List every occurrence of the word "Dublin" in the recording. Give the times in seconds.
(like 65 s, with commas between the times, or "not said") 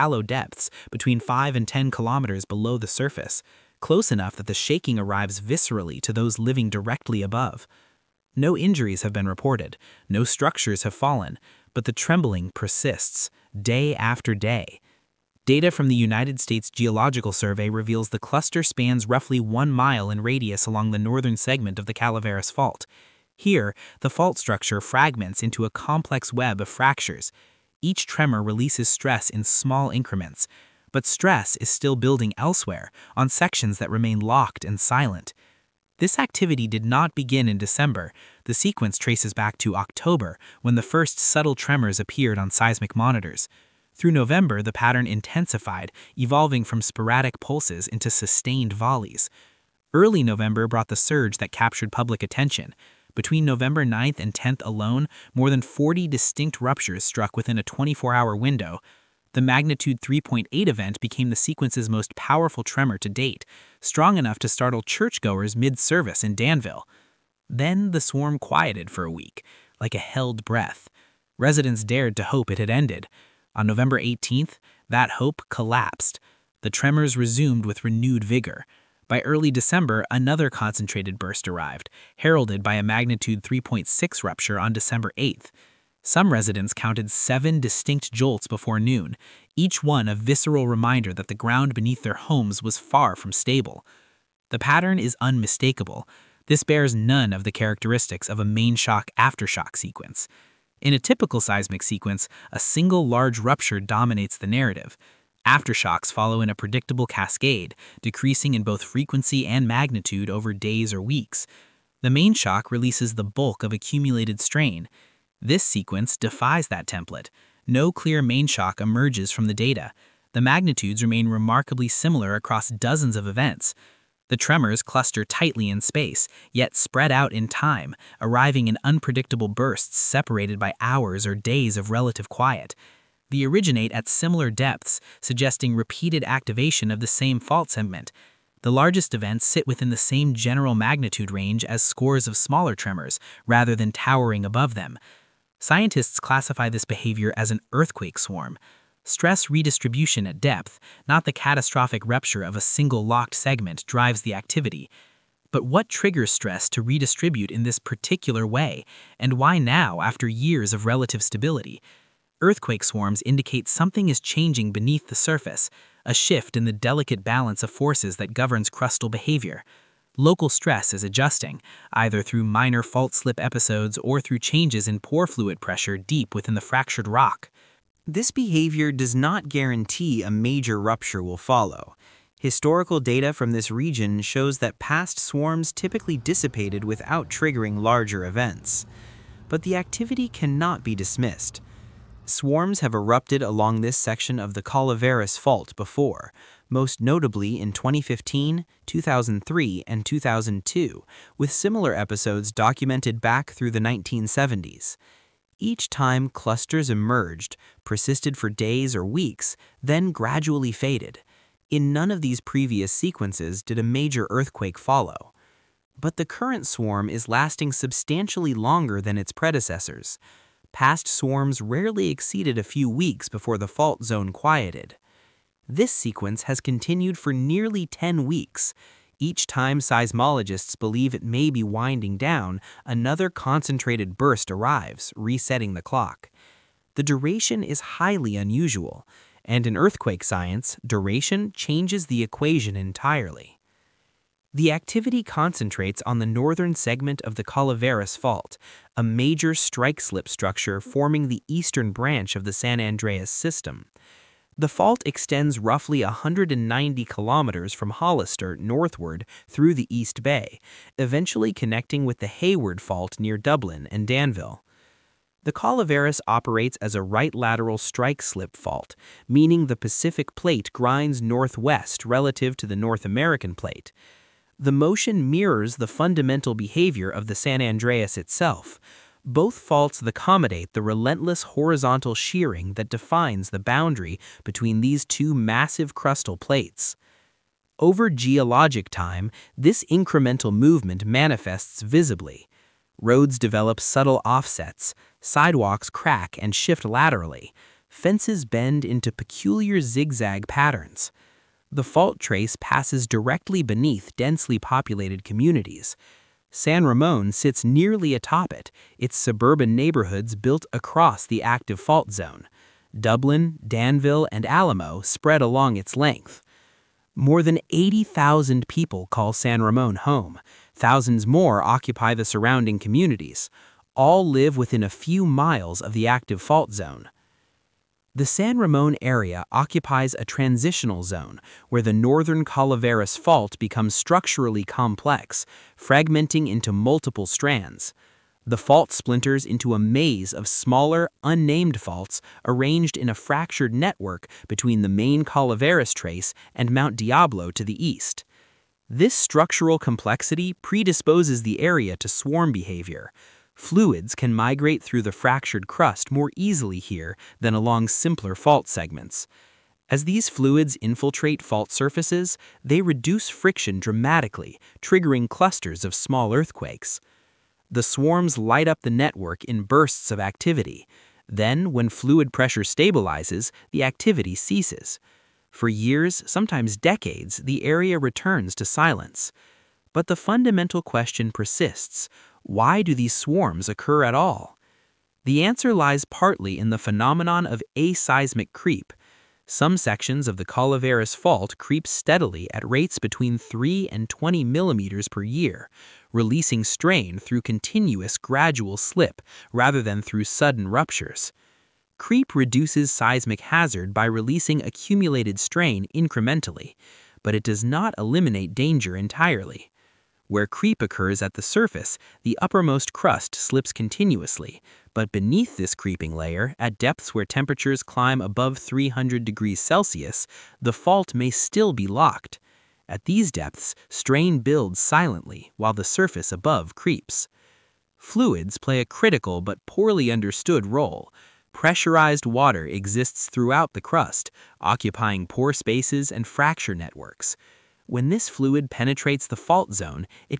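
263 s, 312 s.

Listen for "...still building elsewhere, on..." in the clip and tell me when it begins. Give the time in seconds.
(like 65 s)
31 s.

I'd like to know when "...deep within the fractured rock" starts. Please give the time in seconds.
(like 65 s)
175 s.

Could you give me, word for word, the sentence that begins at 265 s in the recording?
The Calaveras operates as a right lateral strike slip fault, meaning the Pacific plate grinds northwest relative to the North American plate.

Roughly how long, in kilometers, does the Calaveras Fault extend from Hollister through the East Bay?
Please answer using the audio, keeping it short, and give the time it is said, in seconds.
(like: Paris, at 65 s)
190 kilometers, at 256 s.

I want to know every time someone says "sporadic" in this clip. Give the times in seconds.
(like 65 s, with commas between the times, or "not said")
46 s.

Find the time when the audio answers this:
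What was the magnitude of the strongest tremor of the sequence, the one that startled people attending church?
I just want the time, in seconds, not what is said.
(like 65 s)
60 s.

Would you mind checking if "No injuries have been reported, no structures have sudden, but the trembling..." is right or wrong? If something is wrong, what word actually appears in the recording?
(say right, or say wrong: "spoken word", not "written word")
wrong: "fallen", not "sudden".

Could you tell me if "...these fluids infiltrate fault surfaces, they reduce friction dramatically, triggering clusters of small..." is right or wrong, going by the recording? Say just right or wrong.
right.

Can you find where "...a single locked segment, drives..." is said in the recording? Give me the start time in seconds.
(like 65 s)
152 s.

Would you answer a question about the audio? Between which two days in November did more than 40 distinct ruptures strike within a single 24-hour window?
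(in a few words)
November 9th and 10th.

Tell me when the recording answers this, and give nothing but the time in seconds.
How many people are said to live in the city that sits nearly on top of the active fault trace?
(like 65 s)
317 s.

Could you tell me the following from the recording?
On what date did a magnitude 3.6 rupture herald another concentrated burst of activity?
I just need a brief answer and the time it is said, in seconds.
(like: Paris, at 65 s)
December 8th, at 84 s.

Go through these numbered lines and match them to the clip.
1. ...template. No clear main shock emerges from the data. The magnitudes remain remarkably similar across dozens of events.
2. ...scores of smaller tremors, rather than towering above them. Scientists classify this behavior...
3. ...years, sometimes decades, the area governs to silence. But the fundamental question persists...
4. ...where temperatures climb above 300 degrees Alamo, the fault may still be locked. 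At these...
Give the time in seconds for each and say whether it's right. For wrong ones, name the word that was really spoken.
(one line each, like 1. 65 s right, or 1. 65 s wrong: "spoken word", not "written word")
1. 116 s right
2. 141 s right
3. 375 s wrong: "returns", not "governs"
4. 417 s wrong: "Celsius", not "Alamo".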